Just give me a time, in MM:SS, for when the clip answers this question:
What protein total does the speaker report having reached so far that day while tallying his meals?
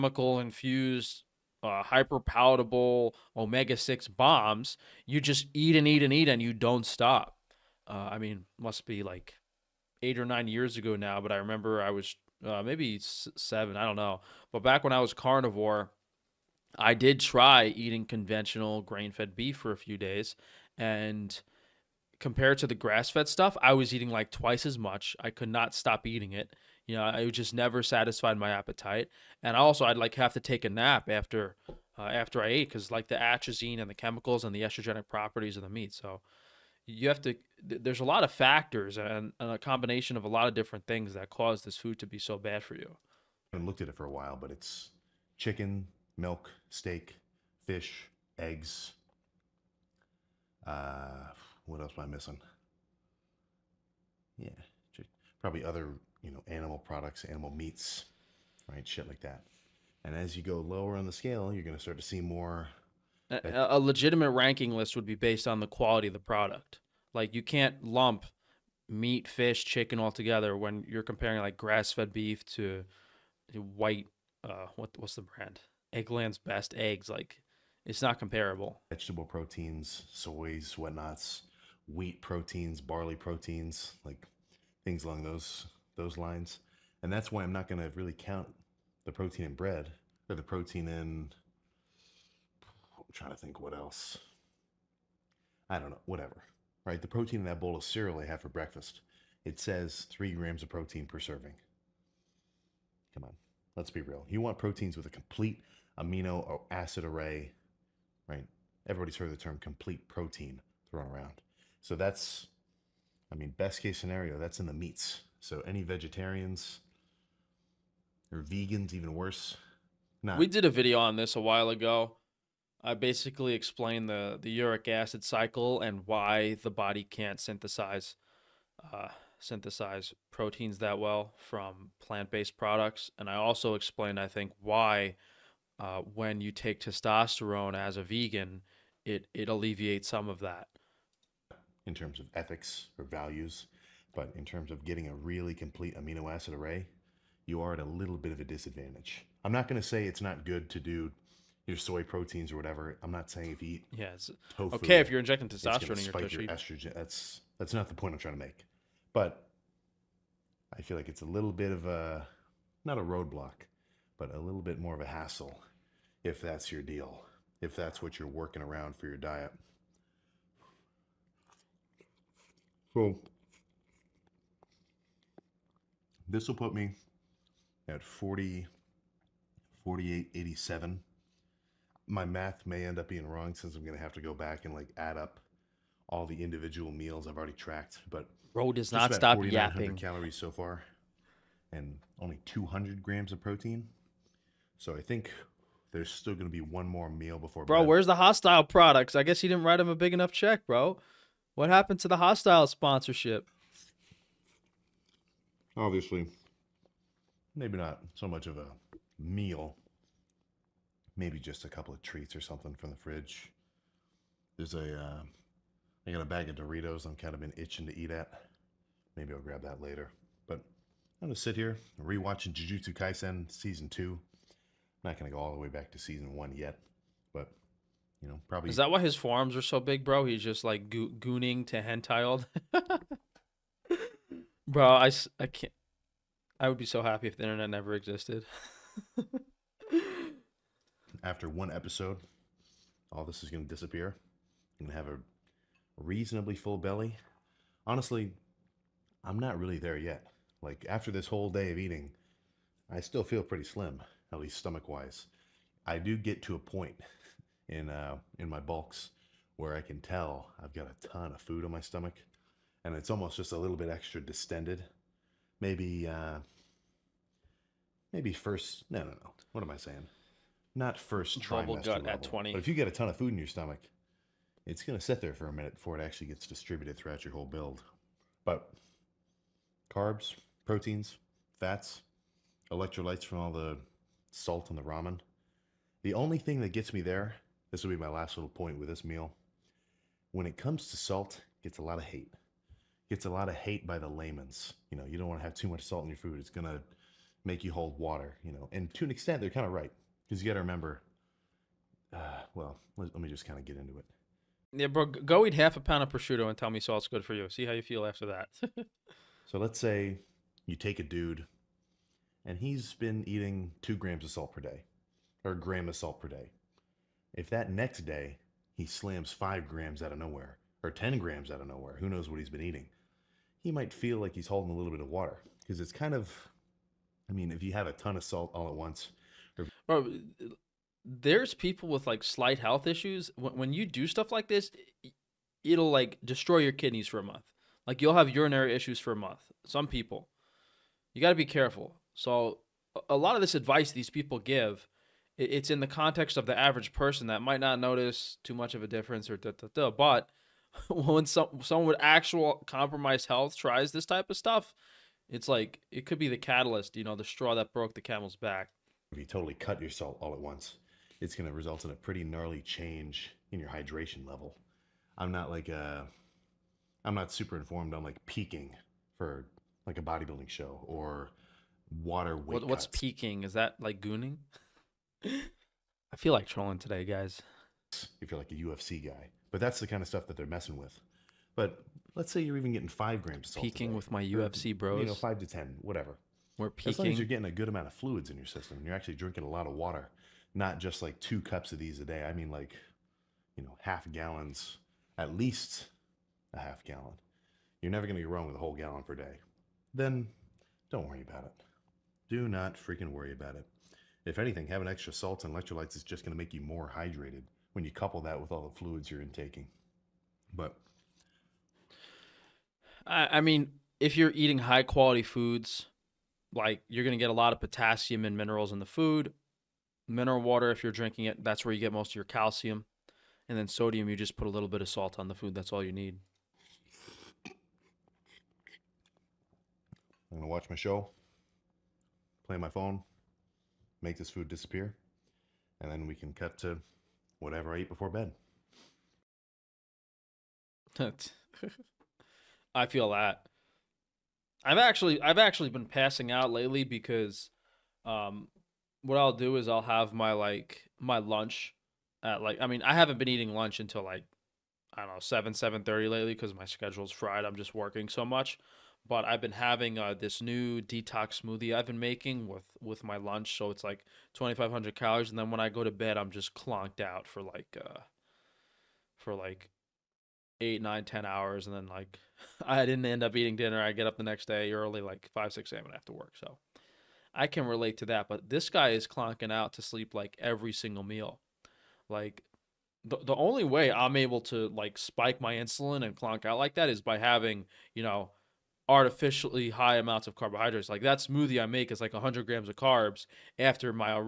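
03:12.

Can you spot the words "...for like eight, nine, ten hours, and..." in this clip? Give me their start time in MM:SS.
07:49.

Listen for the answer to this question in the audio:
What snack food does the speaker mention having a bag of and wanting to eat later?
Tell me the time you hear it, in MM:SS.
03:36.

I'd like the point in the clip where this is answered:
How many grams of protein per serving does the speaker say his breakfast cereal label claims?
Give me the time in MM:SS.
01:40.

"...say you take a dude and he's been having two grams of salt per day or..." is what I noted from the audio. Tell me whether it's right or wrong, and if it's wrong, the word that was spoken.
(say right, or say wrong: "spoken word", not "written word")
wrong: "eating", not "having".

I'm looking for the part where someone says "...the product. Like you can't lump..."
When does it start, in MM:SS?
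01:06.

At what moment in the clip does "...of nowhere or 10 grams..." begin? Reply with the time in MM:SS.
05:20.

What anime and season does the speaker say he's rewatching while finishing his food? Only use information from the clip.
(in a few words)
Jujutsu Kaisen Season 2.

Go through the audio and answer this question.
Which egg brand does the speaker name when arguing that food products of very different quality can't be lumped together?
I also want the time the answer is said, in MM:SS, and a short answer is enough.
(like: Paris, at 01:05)
Eggland's Best, at 01:15.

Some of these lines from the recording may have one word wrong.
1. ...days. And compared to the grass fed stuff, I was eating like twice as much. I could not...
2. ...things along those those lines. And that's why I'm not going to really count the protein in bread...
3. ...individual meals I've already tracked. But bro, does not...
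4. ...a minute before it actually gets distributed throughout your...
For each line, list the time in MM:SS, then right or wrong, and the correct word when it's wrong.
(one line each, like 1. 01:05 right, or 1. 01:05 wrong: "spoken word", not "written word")
1. 00:19 right
2. 01:24 right
3. 03:06 right
4. 04:35 right.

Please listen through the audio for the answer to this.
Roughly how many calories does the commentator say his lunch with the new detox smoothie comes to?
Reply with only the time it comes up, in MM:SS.
07:44.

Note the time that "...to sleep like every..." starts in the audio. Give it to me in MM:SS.
07:59.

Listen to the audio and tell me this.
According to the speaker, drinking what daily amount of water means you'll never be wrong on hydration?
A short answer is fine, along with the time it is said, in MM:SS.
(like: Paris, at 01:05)
a whole gallon, at 06:38.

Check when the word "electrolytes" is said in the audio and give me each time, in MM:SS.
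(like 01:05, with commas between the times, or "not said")
04:42, 06:45.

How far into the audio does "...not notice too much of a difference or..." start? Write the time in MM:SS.
05:47.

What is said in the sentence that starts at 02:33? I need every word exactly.
I'm not saying if you eat yeah, tofu, okay if you're injecting testosterone in your spike your estrogen.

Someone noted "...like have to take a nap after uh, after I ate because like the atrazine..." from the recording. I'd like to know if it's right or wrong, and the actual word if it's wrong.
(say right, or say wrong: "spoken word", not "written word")
right.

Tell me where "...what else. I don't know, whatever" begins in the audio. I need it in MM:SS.
01:33.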